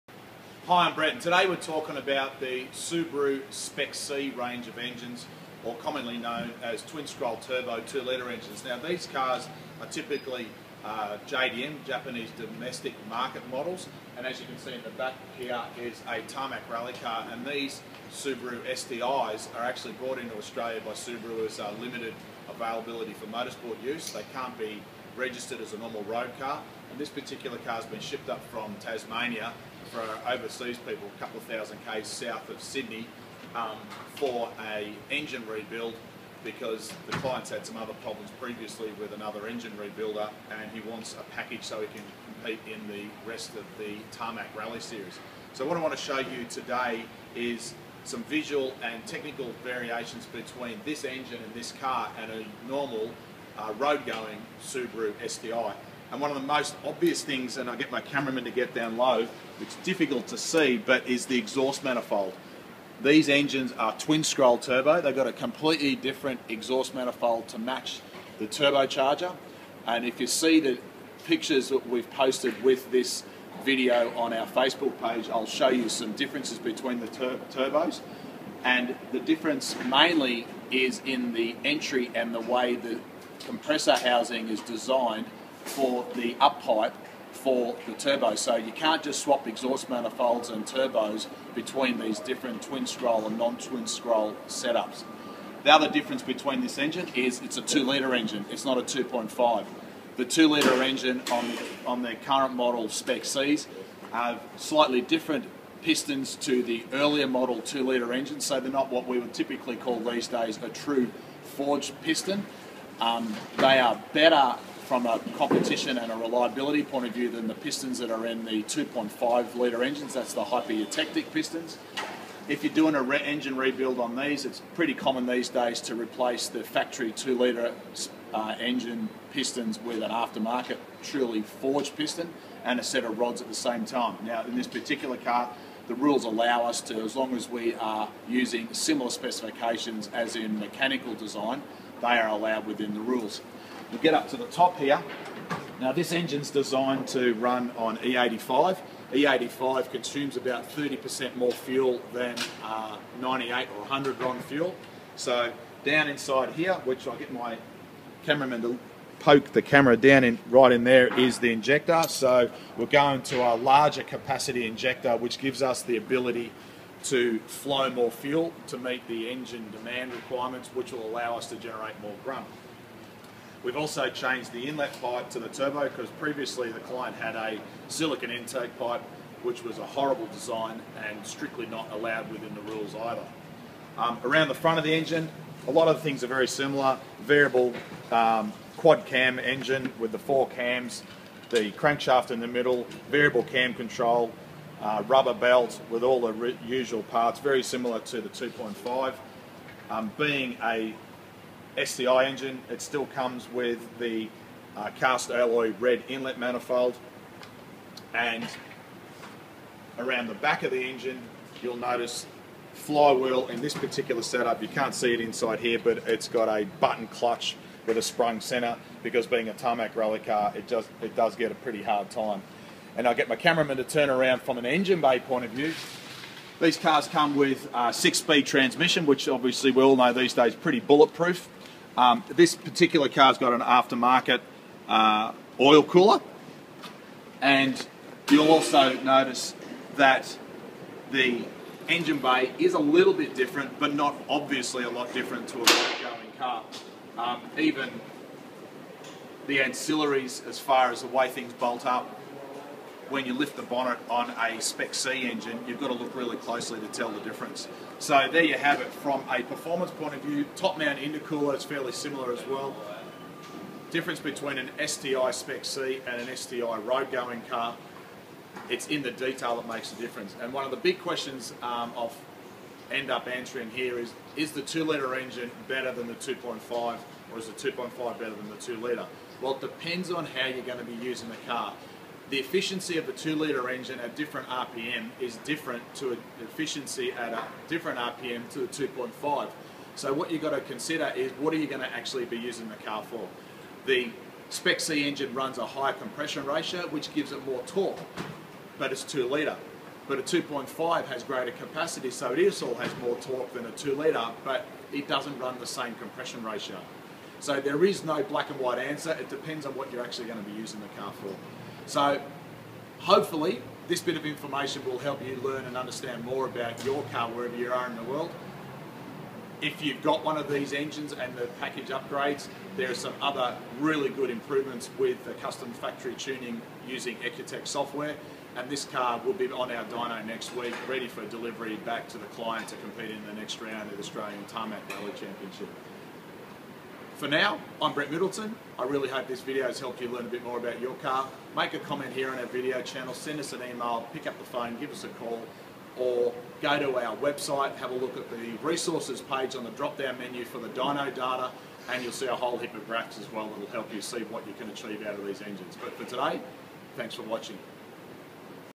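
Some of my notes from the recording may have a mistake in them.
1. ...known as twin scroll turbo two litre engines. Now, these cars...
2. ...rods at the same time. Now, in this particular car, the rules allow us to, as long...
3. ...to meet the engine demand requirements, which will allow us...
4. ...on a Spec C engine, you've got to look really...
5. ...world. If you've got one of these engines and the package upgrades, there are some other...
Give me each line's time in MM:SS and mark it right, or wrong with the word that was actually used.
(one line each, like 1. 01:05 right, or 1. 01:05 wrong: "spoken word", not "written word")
1. 00:06 right
2. 02:13 right
3. 02:48 right
4. 04:14 right
5. 05:18 right.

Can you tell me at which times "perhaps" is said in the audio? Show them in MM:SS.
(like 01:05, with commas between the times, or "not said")
not said.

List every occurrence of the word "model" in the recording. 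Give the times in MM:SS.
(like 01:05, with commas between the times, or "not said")
00:13, 01:42, 01:47.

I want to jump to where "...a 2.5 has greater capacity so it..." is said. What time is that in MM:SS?
05:00.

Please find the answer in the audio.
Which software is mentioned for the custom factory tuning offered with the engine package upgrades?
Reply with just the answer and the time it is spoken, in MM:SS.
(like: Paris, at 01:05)
EcuTek, at 05:27.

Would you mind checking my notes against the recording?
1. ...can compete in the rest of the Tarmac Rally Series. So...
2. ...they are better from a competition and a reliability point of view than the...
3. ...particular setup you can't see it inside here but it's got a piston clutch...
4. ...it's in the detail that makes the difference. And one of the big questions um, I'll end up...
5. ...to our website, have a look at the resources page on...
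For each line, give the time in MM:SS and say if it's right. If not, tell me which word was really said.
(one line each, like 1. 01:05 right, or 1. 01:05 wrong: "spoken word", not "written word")
1. 00:41 right
2. 01:53 right
3. 03:33 wrong: "button", not "piston"
4. 04:28 right
5. 05:46 right.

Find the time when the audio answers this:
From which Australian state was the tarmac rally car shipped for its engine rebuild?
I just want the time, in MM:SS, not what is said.
00:28.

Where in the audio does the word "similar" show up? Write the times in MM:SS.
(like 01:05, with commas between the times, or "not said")
02:18, 03:06, 03:17, 04:21.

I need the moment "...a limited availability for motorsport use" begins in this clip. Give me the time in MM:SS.
00:21.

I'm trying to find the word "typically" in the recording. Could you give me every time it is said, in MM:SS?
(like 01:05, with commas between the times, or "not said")
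00:09, 01:49.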